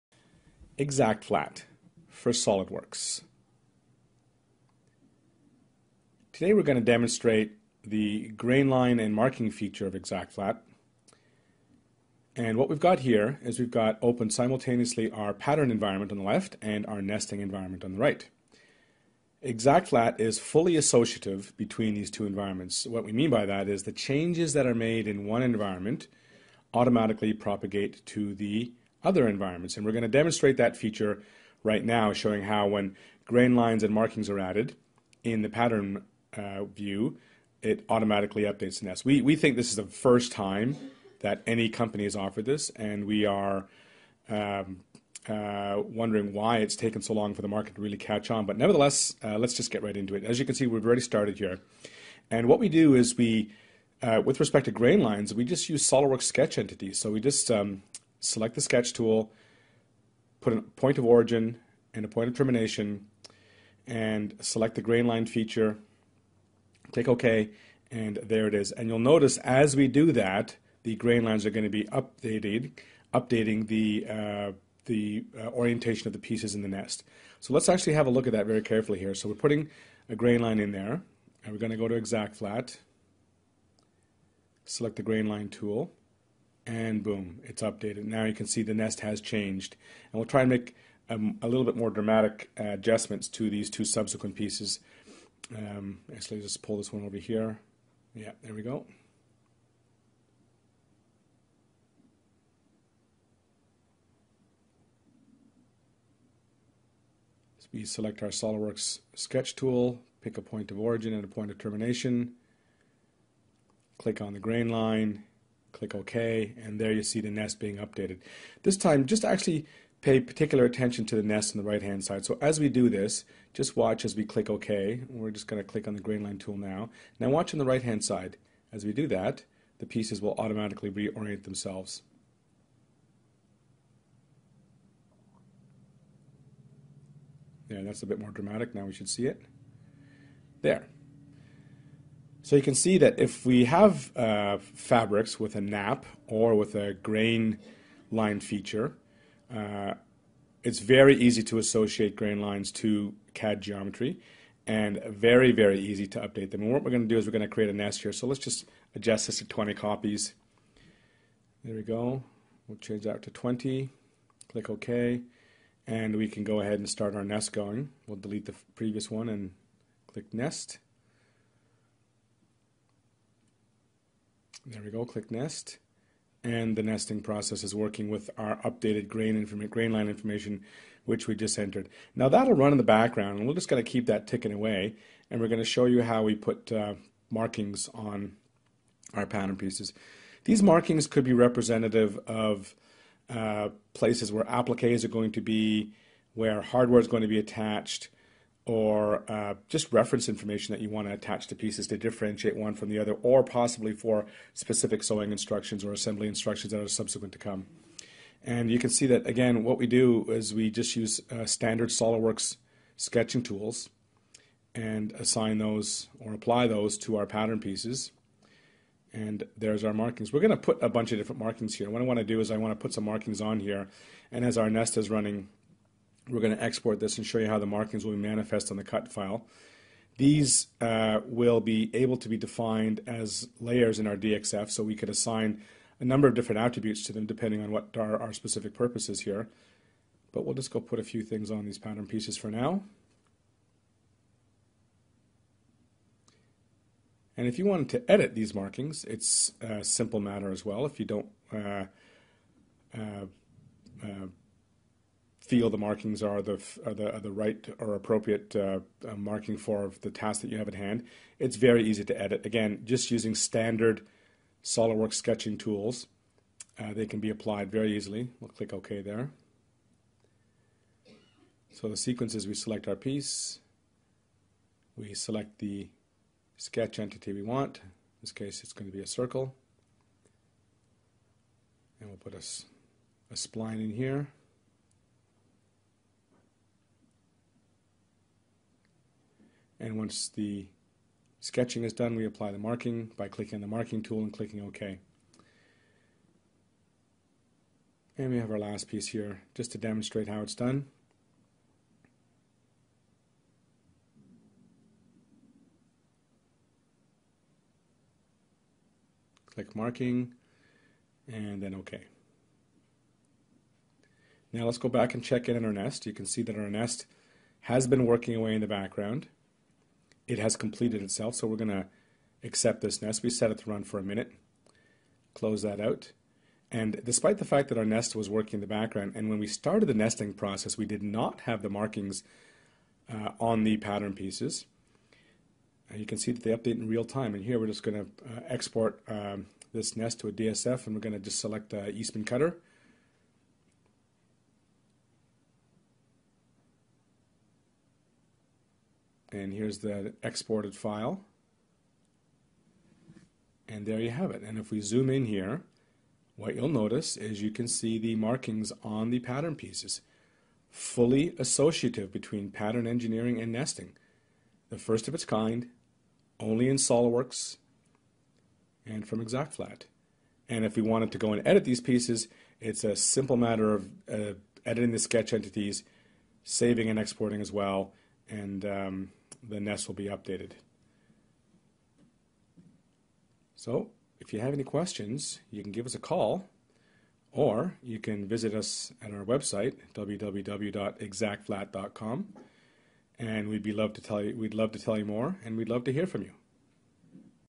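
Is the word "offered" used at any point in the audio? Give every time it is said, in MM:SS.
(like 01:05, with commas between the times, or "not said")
00:42.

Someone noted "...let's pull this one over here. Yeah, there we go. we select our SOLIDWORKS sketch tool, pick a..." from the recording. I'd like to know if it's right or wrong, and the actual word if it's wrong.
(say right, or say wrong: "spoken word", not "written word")
right.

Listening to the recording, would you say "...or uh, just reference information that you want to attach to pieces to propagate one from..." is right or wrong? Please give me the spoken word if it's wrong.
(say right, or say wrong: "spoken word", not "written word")
wrong: "differentiate", not "propagate".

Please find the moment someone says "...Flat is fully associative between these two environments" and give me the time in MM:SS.
00:19.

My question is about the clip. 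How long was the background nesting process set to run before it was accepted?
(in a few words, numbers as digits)
A minute.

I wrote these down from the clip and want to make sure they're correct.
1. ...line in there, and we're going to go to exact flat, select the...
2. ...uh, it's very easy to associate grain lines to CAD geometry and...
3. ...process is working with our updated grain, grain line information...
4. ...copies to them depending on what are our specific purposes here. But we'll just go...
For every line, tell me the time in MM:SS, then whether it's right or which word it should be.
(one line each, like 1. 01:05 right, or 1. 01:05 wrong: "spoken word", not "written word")
1. 01:20 right
2. 02:29 right
3. 02:57 right
4. 03:56 wrong: "attributes", not "copies".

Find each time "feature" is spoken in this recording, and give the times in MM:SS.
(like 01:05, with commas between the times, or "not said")
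00:09, 00:30, 01:05, 02:28.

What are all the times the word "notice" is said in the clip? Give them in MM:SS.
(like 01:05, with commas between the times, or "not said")
01:08, 05:56.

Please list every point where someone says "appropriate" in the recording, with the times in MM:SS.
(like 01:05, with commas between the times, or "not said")
04:17.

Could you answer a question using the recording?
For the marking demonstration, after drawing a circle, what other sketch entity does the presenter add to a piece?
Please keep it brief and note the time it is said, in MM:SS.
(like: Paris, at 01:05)
A spline, at 04:43.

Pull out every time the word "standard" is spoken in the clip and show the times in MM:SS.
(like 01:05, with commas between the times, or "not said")
03:31, 04:23.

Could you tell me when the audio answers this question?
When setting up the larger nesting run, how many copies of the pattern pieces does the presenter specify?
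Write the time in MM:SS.
02:39.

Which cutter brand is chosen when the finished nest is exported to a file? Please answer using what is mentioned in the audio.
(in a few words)
Eastman.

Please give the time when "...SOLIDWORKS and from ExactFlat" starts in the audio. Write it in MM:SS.
06:06.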